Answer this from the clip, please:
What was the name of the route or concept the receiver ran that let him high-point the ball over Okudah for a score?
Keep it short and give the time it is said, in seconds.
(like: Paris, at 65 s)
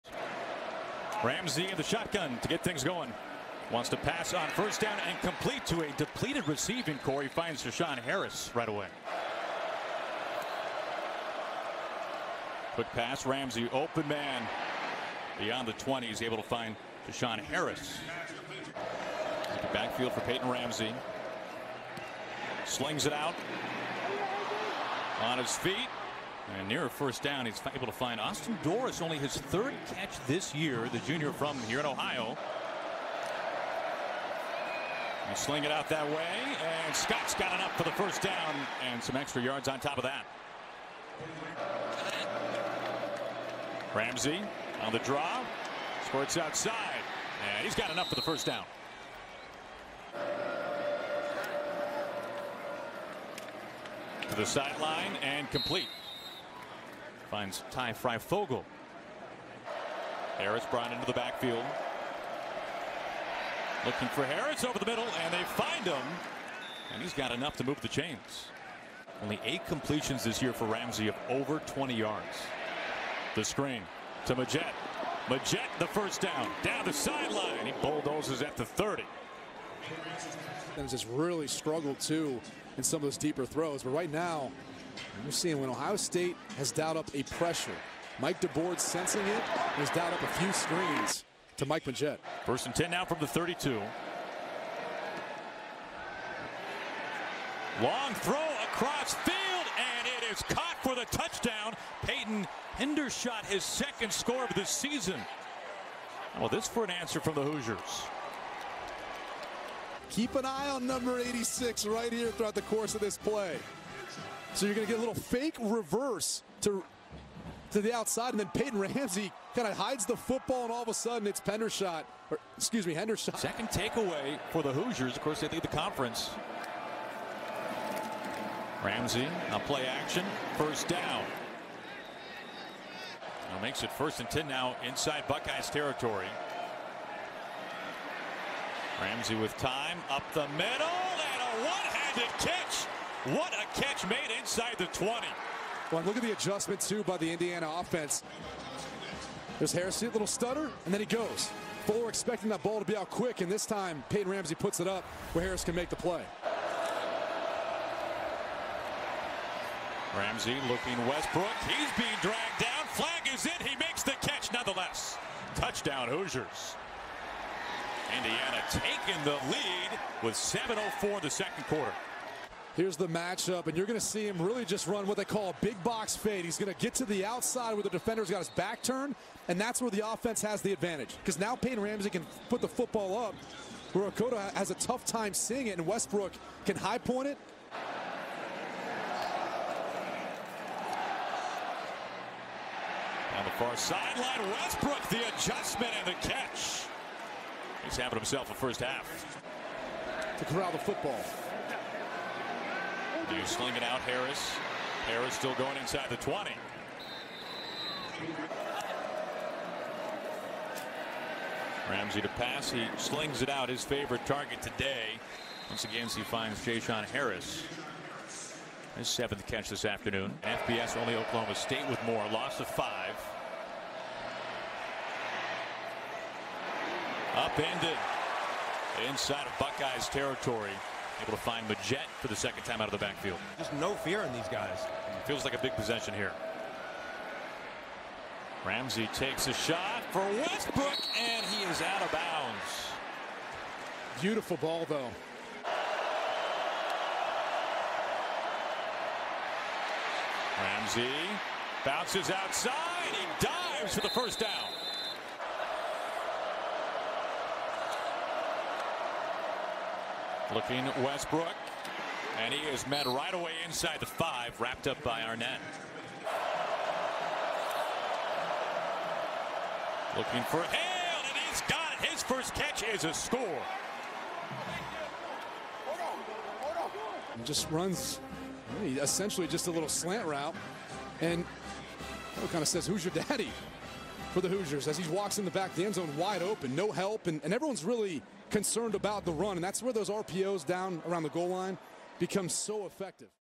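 big box fade, at 175 s.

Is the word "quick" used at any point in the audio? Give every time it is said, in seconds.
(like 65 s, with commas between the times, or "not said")
12 s, 153 s.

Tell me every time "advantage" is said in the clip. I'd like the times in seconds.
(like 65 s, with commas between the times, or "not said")
180 s.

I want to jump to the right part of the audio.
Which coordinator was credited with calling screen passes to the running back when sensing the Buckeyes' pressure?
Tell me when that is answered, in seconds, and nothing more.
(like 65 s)
88 s.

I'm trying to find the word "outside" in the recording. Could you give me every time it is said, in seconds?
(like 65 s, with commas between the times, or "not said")
46 s, 117 s, 177 s, 252 s.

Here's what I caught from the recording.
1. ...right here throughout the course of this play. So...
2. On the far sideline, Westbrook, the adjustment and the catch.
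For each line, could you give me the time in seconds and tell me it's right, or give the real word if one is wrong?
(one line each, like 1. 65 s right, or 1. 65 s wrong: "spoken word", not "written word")
1. 111 s right
2. 193 s right.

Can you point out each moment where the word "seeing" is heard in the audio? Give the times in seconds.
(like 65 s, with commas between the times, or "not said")
85 s, 185 s.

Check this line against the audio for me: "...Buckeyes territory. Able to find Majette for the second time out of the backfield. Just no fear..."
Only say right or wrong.
right.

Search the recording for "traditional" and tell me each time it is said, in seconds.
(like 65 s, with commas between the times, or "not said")
not said.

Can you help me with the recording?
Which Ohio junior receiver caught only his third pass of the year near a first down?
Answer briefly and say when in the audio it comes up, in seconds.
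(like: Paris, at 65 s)
Austin Dorris, at 28 s.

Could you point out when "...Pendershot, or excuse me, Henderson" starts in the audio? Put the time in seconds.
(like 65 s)
121 s.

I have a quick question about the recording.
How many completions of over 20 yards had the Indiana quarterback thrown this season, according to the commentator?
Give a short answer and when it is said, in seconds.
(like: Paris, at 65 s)
8, at 69 s.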